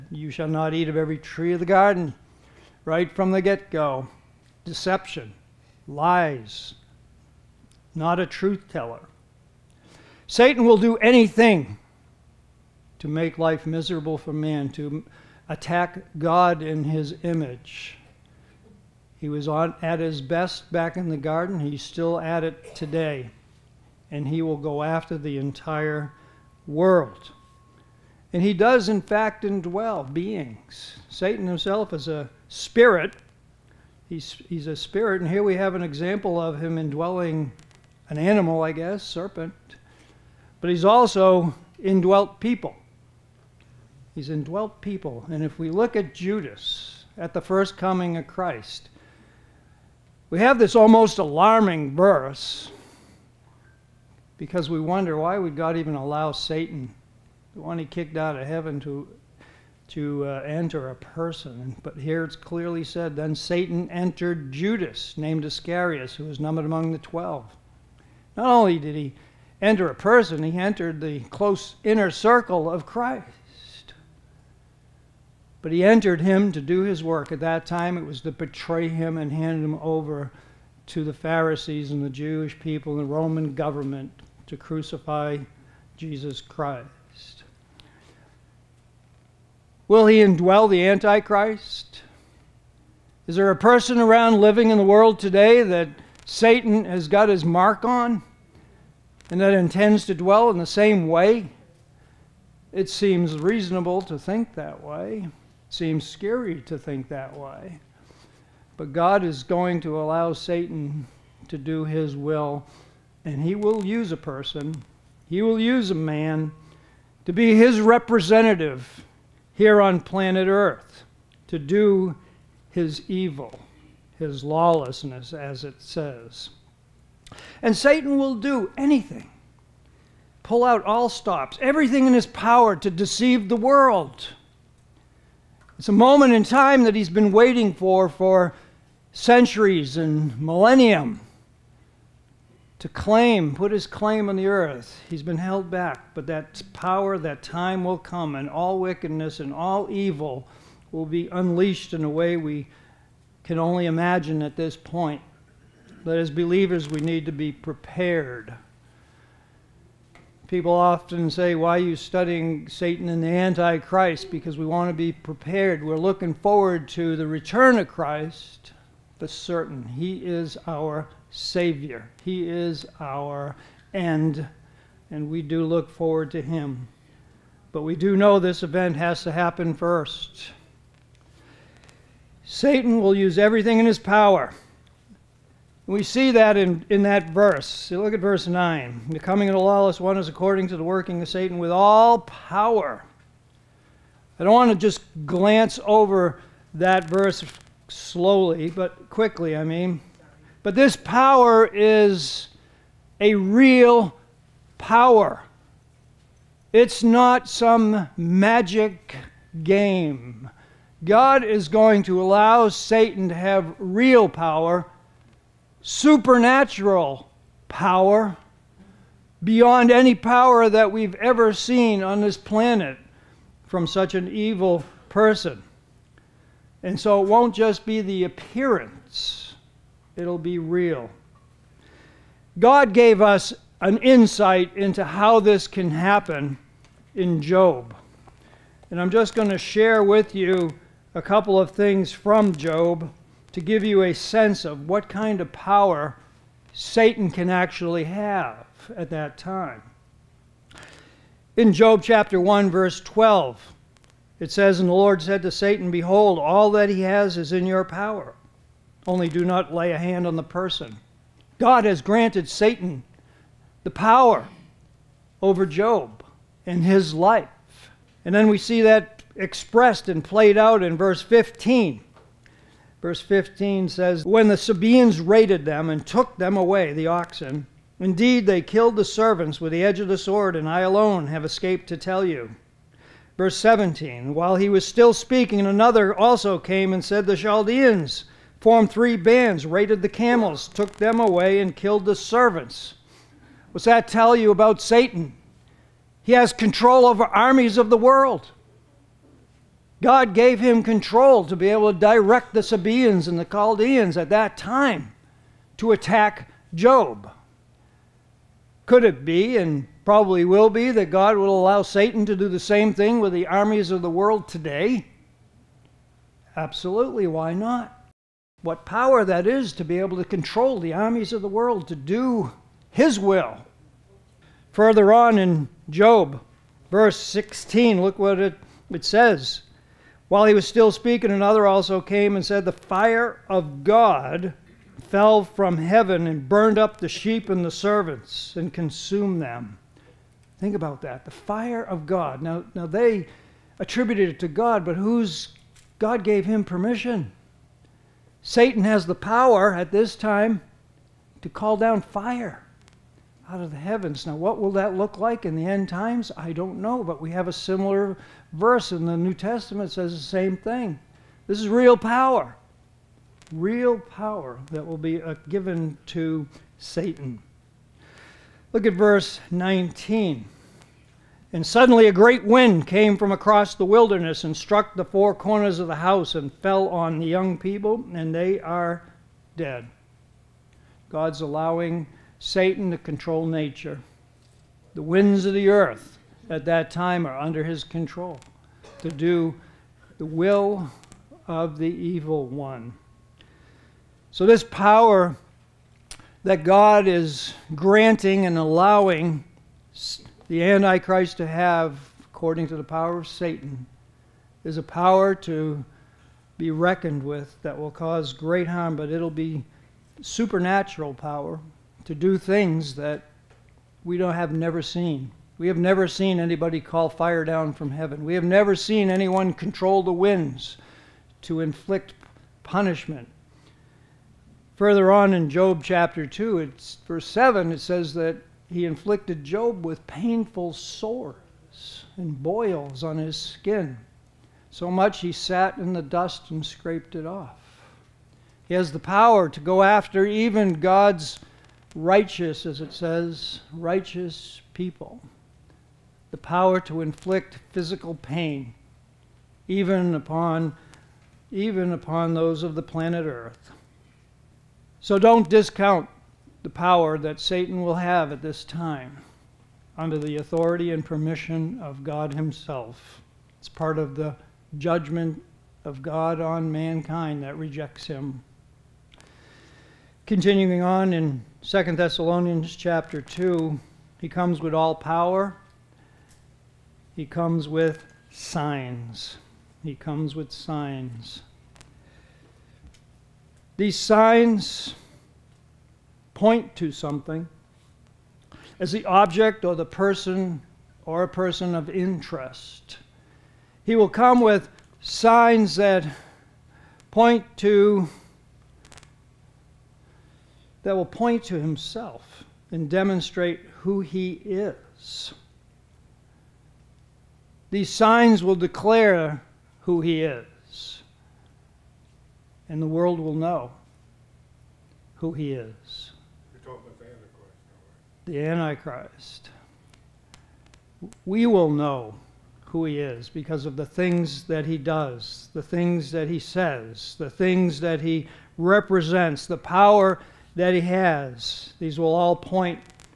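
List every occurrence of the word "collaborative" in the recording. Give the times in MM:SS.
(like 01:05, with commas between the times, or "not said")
not said.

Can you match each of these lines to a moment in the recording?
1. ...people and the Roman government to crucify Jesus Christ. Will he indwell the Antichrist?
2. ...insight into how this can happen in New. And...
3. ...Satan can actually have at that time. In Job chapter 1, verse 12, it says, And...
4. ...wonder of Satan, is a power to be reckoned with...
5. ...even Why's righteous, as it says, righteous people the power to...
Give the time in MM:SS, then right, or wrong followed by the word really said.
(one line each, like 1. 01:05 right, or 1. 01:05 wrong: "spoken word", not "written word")
1. 01:22 right
2. 03:53 wrong: "Job", not "New"
3. 04:06 right
4. 06:42 wrong: "power", not "wonder"
5. 07:20 wrong: "God", not "Why".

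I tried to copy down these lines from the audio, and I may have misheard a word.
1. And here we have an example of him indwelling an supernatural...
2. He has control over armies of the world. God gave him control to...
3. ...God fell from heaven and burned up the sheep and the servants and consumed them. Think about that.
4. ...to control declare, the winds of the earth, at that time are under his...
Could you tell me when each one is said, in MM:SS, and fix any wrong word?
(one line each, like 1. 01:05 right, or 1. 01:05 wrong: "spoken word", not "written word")
1. 00:35 wrong: "animal", not "supernatural"
2. 04:56 right
3. 05:33 right
4. 06:22 wrong: "nature", not "declare".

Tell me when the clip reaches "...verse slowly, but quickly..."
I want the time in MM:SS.
03:17.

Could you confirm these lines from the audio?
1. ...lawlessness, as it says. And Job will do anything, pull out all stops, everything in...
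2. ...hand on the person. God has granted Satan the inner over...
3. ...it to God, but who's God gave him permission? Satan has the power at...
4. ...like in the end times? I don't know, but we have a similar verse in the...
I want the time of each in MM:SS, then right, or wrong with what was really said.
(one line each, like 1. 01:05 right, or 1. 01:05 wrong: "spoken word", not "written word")
1. 02:04 wrong: "Satan", not "Job"
2. 04:19 wrong: "power", not "inner"
3. 05:44 right
4. 05:55 right.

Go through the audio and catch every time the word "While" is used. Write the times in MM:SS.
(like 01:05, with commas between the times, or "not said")
04:44, 05:30.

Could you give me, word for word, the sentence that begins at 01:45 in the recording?
It seems scary to think that way.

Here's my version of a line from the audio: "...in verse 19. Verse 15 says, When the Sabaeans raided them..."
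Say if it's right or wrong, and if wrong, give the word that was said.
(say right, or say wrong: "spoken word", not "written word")
wrong: "15", not "19".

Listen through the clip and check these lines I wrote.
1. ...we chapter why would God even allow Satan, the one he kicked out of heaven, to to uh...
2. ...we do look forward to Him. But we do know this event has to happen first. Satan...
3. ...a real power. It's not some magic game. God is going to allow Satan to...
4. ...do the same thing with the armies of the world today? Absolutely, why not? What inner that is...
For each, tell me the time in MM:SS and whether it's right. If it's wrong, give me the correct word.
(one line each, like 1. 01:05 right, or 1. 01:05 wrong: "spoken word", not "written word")
1. 00:54 wrong: "wonder", not "chapter"
2. 02:55 right
3. 03:23 right
4. 05:12 wrong: "power", not "inner".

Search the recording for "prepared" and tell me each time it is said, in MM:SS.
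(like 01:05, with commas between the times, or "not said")
02:37, 02:45.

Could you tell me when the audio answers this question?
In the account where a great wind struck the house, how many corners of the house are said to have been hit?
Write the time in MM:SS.
06:15.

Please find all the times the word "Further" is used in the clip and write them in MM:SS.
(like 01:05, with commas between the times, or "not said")
05:24, 07:04.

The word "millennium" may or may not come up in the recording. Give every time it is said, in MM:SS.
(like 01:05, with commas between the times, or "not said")
02:20.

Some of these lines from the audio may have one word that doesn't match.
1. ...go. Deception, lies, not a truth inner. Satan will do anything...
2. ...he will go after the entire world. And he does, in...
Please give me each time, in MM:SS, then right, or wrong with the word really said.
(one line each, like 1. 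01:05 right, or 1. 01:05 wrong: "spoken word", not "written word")
1. 00:03 wrong: "teller", not "inner"
2. 00:24 right.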